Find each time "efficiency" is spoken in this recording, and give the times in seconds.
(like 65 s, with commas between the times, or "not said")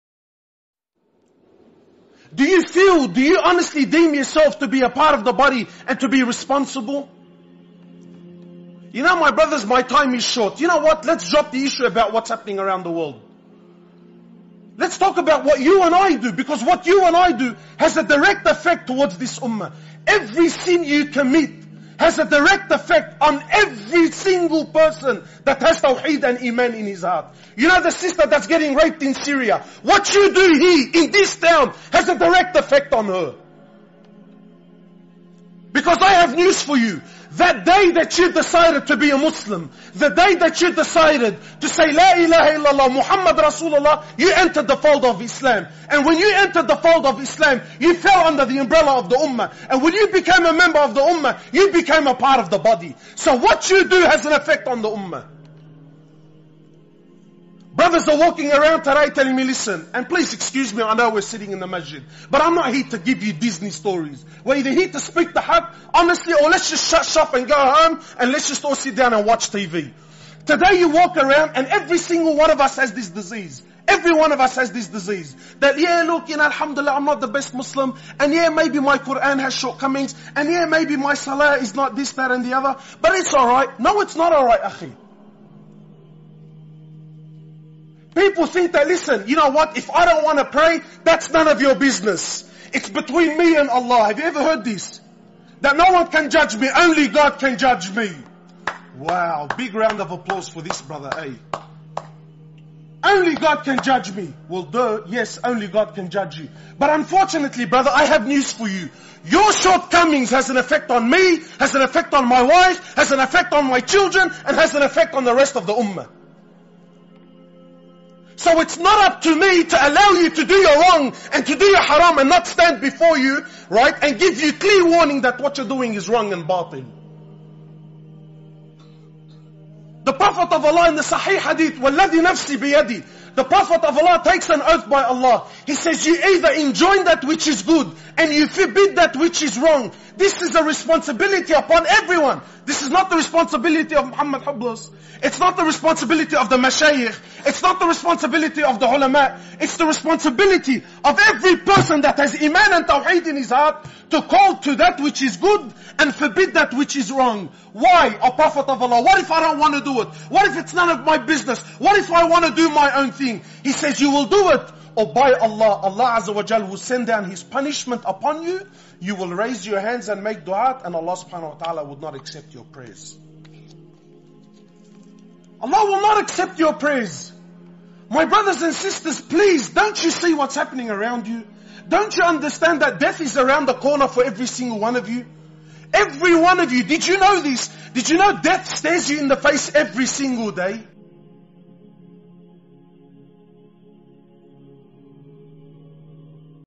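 not said.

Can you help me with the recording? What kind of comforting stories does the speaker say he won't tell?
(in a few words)
Disney stories.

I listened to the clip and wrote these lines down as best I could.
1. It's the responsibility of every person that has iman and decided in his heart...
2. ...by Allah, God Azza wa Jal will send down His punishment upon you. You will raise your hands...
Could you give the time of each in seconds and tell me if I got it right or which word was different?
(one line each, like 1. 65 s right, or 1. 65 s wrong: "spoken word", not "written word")
1. 149 s wrong: "tawheed", not "decided"
2. 165 s wrong: "Allah", not "God".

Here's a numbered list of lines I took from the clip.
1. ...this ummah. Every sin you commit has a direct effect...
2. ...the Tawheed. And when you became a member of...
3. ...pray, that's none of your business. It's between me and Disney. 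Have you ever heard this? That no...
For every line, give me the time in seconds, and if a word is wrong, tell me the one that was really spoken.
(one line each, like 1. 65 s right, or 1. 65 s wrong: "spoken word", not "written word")
1. 19 s right
2. 49 s wrong: "Ummah", not "Tawheed"
3. 90 s wrong: "Allah", not "Disney".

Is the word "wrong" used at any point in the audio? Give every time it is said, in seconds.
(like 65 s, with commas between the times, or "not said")
120 s, 126 s, 139 s, 157 s.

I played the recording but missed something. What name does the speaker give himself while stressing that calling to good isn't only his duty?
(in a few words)
Muhammad Hoblos.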